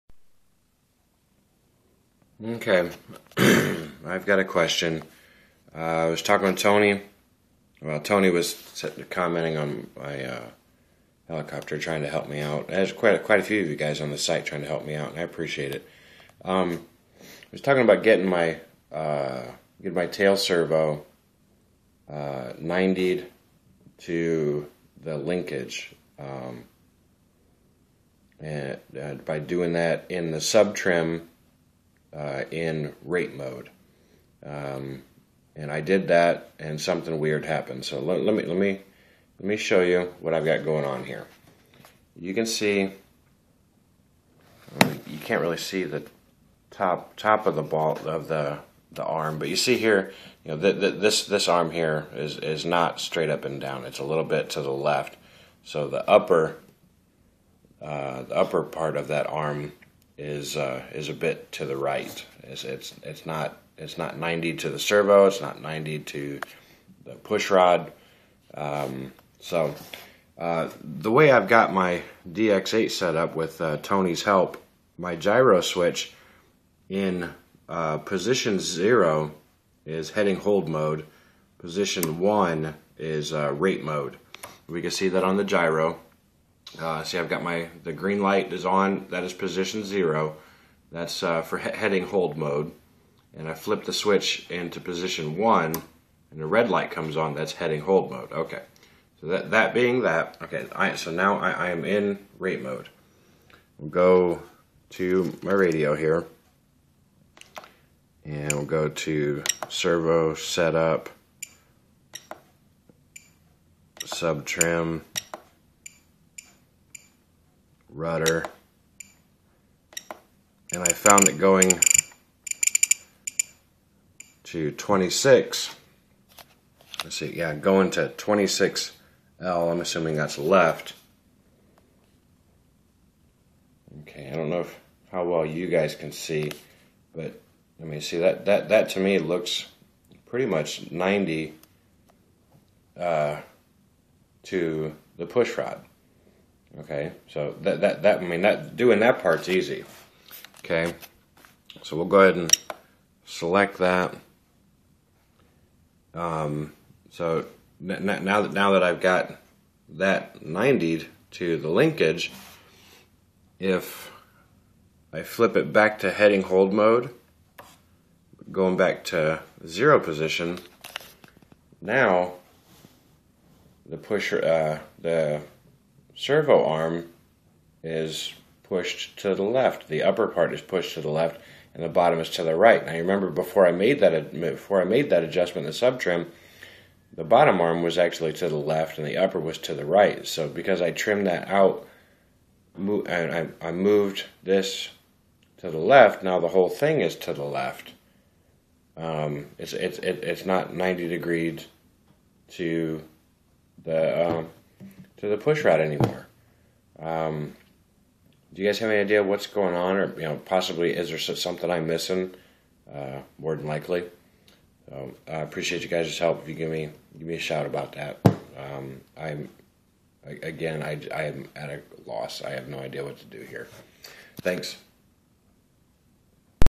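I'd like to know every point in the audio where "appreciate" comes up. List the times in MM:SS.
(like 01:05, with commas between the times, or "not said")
00:15, 03:35.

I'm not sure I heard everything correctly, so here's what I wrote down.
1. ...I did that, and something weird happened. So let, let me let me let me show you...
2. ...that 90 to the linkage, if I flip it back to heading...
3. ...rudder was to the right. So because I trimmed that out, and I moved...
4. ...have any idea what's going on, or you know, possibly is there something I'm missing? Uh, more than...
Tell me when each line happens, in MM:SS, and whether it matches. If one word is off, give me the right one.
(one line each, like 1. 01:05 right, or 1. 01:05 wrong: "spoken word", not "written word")
1. 00:35 right
2. 02:39 right
3. 03:09 wrong: "upper", not "rudder"
4. 03:28 right.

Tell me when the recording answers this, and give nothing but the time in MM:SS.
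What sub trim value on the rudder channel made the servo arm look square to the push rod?
02:08.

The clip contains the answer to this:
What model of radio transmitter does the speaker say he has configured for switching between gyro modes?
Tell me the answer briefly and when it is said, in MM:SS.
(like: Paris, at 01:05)
DX8, at 01:12.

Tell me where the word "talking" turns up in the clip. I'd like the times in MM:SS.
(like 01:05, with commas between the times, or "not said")
00:06, 00:17.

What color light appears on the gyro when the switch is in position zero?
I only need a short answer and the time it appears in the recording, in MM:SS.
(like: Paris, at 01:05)
Green, at 01:27.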